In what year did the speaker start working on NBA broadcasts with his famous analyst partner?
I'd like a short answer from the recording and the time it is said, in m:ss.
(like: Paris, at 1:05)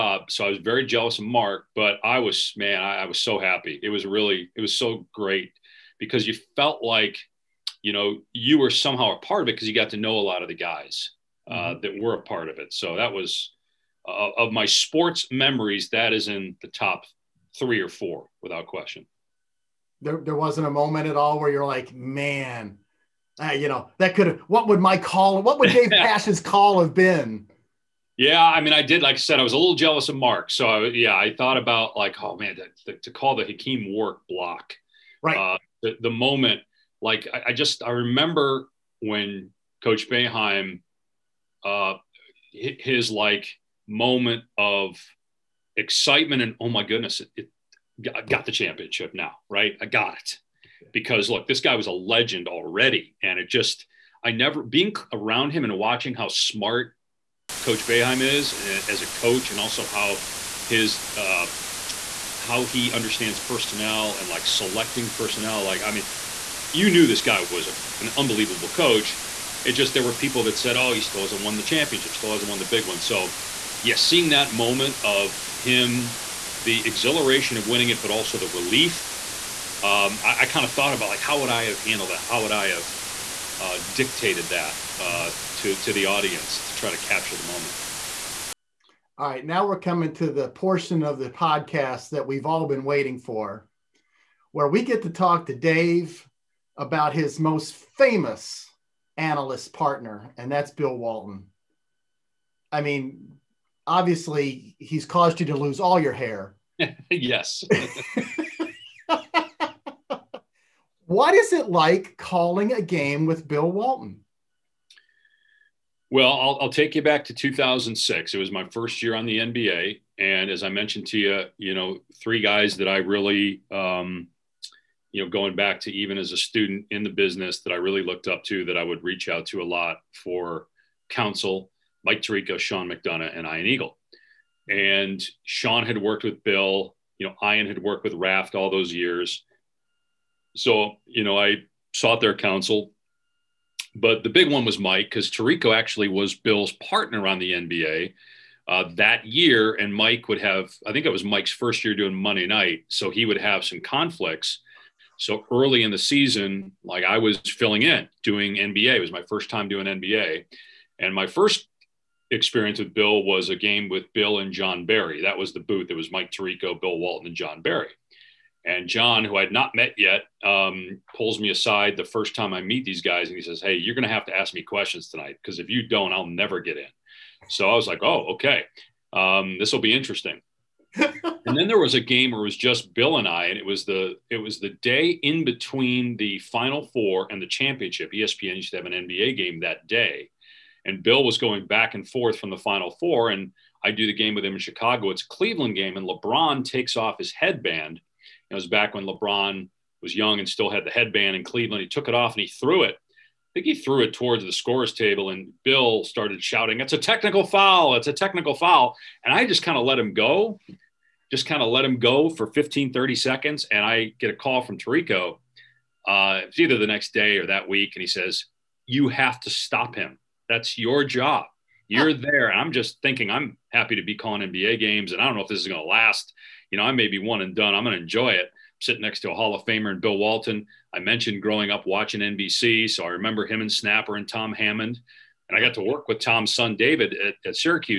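2006, at 1:57.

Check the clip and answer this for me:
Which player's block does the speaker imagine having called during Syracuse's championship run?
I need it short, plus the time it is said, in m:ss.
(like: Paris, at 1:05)
Hakim Warrick, at 0:33.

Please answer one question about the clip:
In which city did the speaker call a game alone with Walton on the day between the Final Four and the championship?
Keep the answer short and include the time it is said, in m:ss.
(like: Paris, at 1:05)
Chicago, at 3:14.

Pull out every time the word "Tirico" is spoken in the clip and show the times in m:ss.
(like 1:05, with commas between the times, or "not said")
2:12, 2:25, 2:46, 3:34.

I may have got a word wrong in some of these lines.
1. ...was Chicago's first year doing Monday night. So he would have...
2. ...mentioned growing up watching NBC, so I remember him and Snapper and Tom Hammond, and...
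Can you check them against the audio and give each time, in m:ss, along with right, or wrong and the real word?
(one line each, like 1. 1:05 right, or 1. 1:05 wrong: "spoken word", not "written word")
1. 2:31 wrong: "Mike", not "Chicago"
2. 3:50 right.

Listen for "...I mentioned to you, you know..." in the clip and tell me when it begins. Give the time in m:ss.
2:00.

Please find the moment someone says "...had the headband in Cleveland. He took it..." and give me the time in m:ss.
3:20.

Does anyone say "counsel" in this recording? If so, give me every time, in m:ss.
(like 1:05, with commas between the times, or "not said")
2:11, 2:22.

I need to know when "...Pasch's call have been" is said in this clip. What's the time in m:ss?
0:25.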